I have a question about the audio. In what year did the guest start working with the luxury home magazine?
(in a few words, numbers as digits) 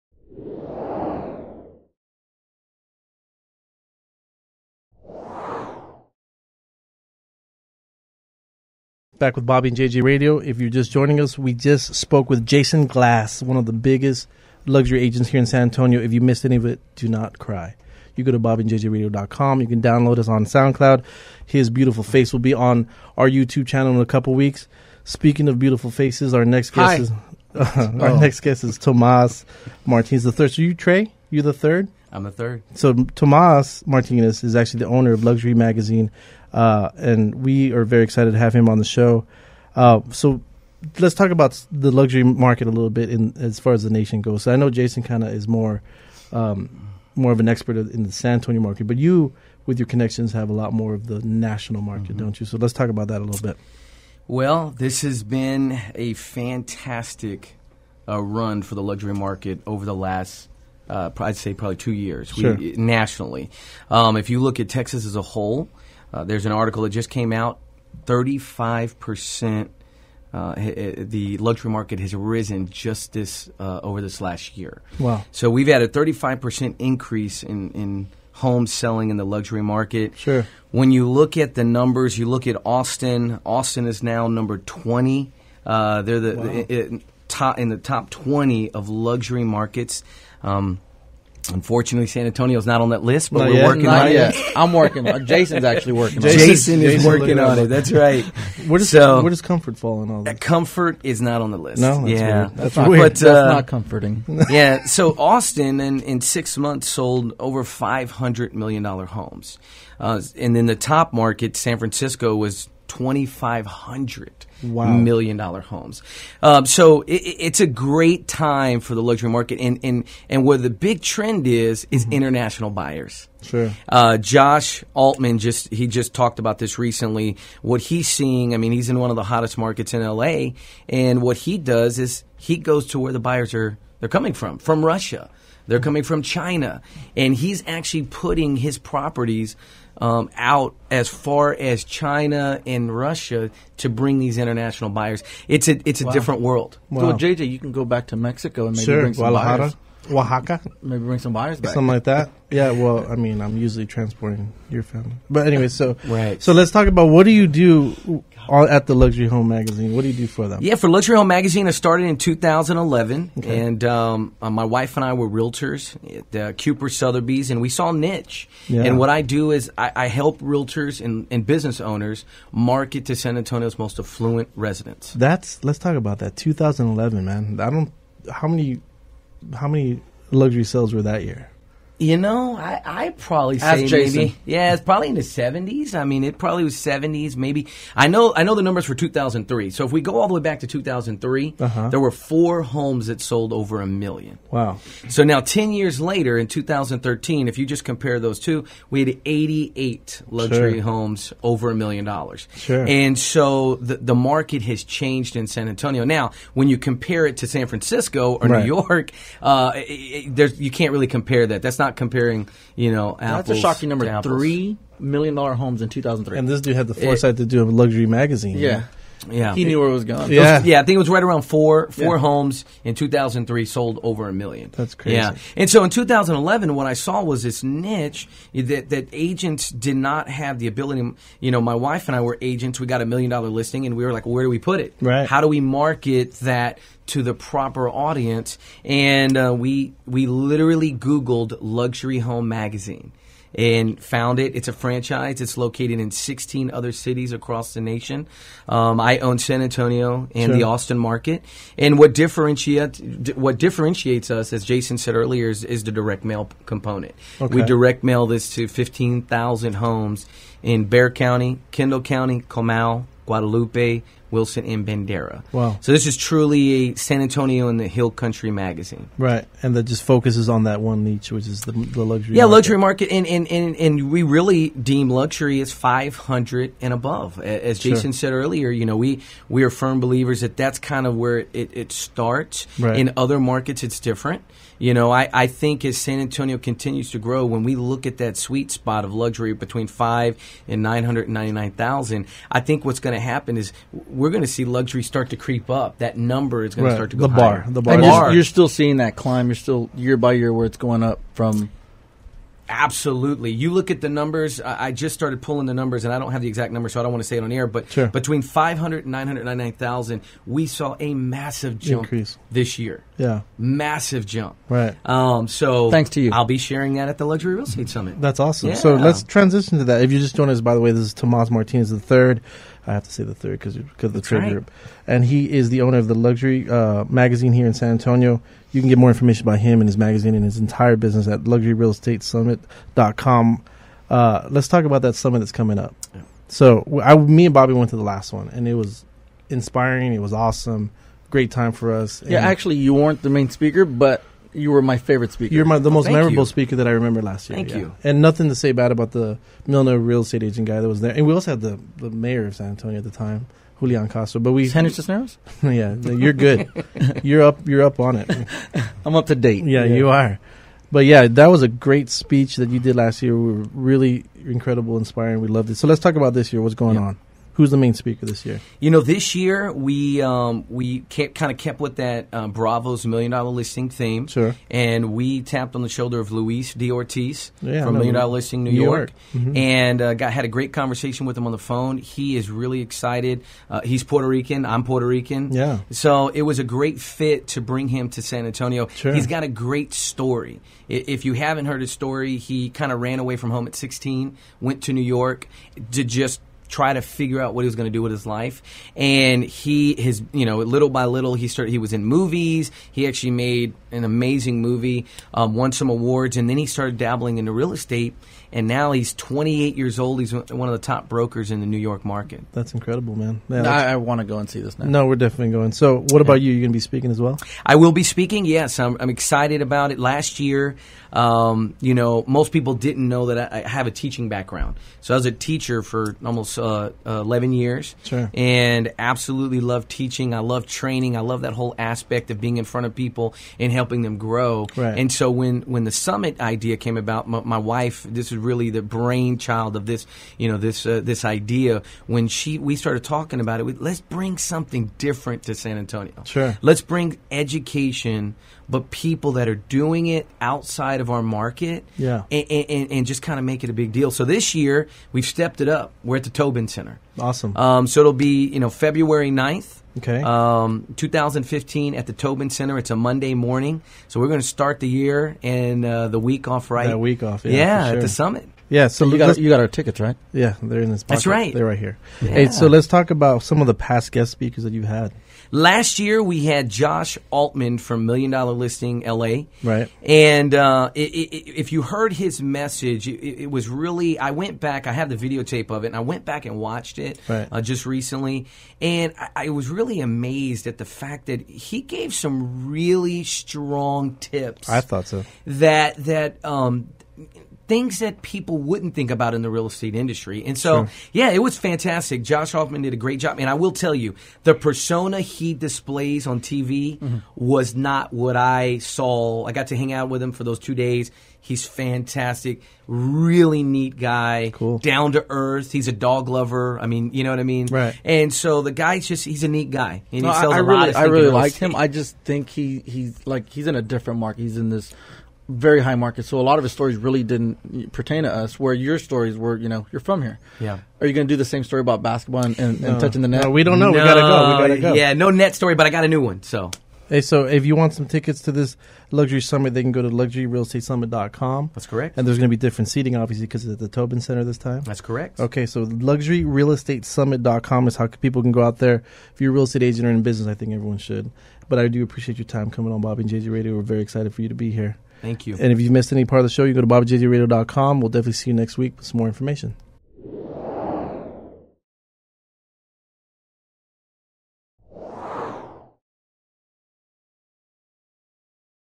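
2011.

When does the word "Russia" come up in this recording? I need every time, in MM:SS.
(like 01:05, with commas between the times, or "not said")
02:14, 02:22.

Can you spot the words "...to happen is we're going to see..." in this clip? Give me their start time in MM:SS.
04:53.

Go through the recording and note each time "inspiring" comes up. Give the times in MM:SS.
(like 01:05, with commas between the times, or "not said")
05:39, 06:04.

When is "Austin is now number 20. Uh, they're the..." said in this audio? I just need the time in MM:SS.
01:23.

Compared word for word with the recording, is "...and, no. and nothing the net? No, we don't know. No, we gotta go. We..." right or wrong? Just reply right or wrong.
wrong.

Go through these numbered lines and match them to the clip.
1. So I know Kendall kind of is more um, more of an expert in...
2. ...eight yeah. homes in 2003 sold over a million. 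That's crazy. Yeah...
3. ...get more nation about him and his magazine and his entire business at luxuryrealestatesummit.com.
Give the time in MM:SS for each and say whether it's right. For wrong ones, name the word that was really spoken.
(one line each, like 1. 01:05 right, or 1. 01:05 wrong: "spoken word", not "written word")
1. 00:44 wrong: "Jason", not "Kendall"
2. 03:41 wrong: "four", not "eight"
3. 05:28 wrong: "information", not "nation".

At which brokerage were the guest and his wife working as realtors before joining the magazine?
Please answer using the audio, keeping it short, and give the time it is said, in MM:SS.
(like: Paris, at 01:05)
Kuper Sotheby's, at 02:46.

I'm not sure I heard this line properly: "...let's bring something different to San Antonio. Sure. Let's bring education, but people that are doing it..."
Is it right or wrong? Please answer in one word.
right.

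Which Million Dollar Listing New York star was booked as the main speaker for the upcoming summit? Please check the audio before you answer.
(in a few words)
Luis D. Ortiz.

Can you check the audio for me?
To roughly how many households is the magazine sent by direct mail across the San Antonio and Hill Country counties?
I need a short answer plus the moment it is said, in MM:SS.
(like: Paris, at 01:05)
15,000, at 04:18.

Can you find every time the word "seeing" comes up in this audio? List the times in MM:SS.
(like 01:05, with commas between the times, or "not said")
02:08, 04:58.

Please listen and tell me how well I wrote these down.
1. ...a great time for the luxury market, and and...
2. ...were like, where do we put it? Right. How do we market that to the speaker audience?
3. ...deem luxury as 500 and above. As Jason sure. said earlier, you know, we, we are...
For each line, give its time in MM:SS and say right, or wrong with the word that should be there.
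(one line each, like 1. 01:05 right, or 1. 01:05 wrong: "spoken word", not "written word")
1. 01:57 right
2. 03:54 wrong: "proper", not "speaker"
3. 04:34 right.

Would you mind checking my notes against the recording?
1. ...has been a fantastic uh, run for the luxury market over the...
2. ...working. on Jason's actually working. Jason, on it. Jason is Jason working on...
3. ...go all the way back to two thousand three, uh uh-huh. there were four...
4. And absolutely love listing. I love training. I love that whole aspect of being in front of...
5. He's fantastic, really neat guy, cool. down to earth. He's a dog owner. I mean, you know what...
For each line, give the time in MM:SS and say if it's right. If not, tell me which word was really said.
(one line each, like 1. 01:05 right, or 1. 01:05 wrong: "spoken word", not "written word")
1. 00:55 right
2. 01:34 right
3. 03:10 right
4. 07:08 wrong: "teaching", not "listing"
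5. 08:31 wrong: "lover", not "owner".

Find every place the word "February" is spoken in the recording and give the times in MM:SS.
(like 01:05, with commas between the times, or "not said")
07:38.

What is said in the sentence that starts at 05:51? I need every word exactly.
And we also had the, the mayor of San Antonio at the time, Julian Castro.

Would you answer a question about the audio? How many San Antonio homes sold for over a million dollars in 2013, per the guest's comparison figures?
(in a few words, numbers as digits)
88.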